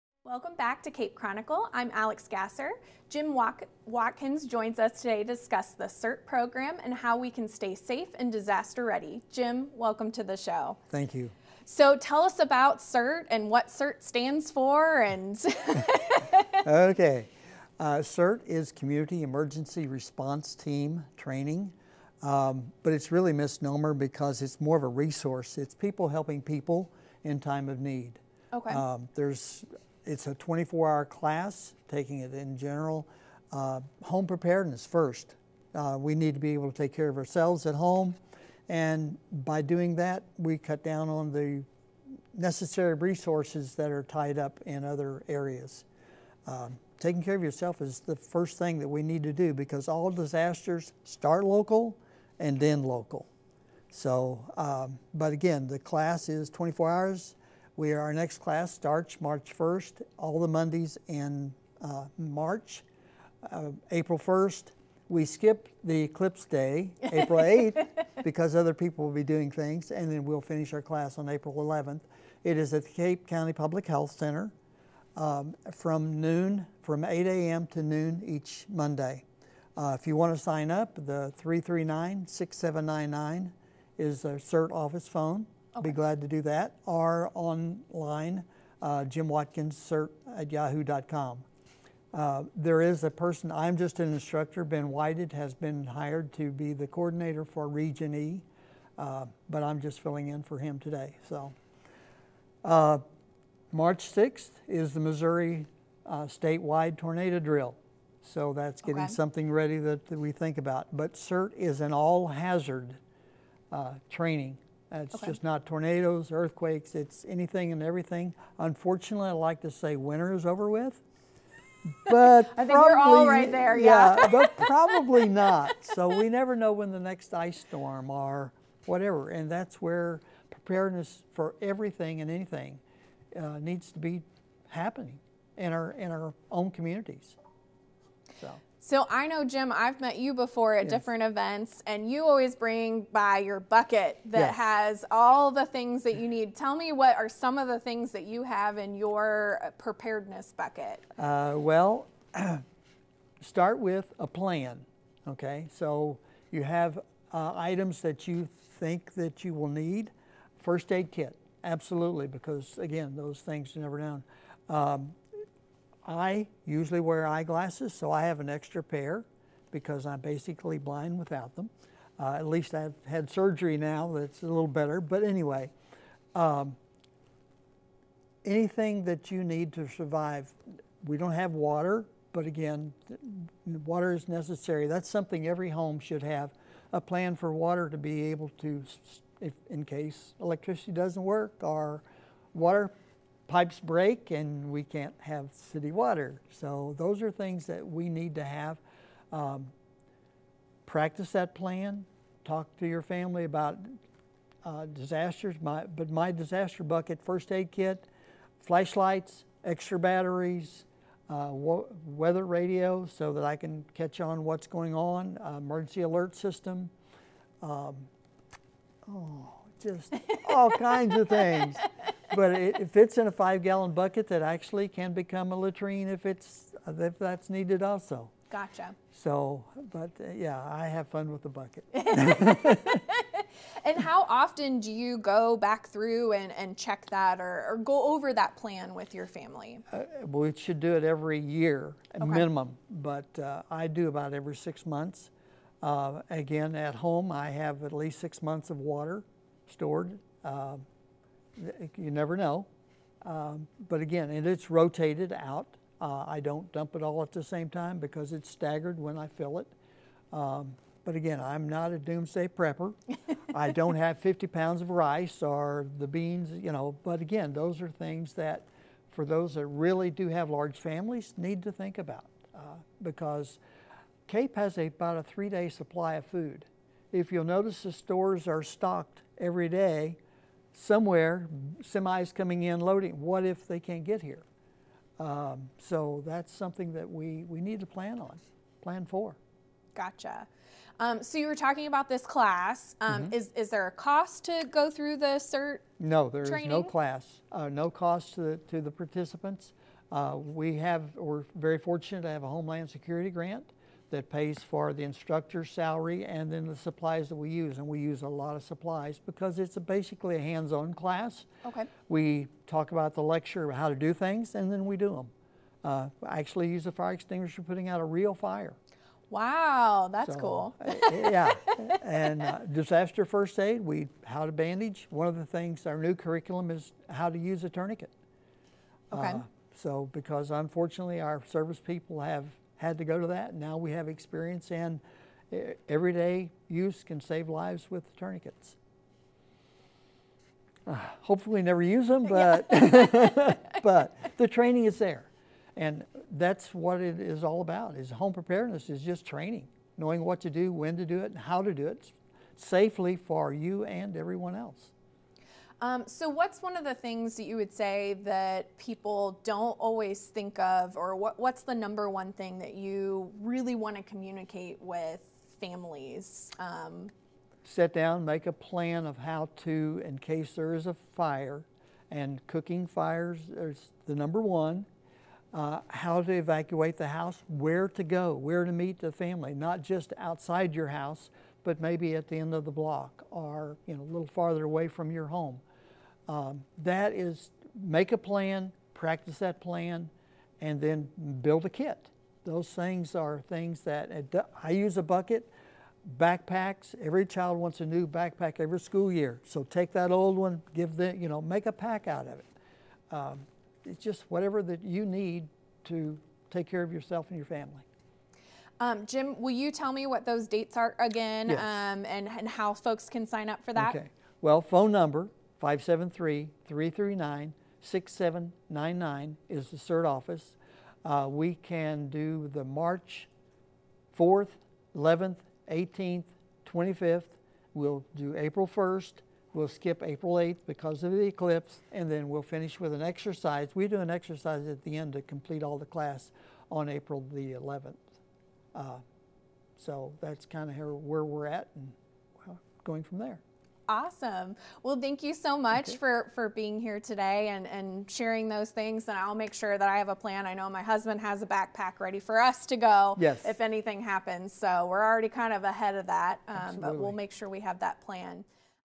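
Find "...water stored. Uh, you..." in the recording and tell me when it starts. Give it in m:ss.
4:08.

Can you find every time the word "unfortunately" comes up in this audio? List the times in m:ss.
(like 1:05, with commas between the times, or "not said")
1:58, 5:30.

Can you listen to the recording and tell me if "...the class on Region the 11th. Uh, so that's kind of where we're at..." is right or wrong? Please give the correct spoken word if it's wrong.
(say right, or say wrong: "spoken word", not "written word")
wrong: "April", not "Region".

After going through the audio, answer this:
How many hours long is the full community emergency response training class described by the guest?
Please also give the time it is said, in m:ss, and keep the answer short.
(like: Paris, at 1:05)
24, at 0:30.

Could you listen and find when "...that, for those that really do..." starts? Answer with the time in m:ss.
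4:28.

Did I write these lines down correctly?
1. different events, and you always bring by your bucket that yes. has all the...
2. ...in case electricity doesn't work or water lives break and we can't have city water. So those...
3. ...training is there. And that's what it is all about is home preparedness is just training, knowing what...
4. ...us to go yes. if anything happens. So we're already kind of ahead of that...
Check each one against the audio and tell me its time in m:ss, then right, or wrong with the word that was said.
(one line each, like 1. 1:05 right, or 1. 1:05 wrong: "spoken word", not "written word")
1. 2:20 right
2. 3:09 wrong: "pipes", not "lives"
3. 5:44 right
4. 7:32 right.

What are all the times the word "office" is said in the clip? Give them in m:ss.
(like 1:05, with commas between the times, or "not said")
1:24, 7:00.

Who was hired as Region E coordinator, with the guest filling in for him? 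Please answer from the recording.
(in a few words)
Ben Whited.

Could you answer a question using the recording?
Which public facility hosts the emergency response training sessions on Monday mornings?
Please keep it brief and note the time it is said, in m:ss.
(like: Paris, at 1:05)
Cape County Public Health Center, at 1:12.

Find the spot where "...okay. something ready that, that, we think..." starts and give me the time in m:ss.
1:49.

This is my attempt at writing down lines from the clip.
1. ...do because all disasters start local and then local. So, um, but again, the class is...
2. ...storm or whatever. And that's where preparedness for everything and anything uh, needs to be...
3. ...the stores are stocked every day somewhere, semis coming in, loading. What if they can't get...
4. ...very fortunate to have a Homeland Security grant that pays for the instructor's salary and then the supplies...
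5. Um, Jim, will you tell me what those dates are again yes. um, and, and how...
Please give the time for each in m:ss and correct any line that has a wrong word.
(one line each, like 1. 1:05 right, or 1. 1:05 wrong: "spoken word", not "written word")
1. 0:49 right
2. 2:07 right
3. 4:37 right
4. 5:01 right
5. 6:48 right.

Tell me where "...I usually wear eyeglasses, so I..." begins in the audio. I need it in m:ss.
2:46.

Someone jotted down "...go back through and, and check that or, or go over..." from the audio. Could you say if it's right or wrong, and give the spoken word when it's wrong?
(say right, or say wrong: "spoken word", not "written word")
right.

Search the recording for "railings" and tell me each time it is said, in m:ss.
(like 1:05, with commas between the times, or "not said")
not said.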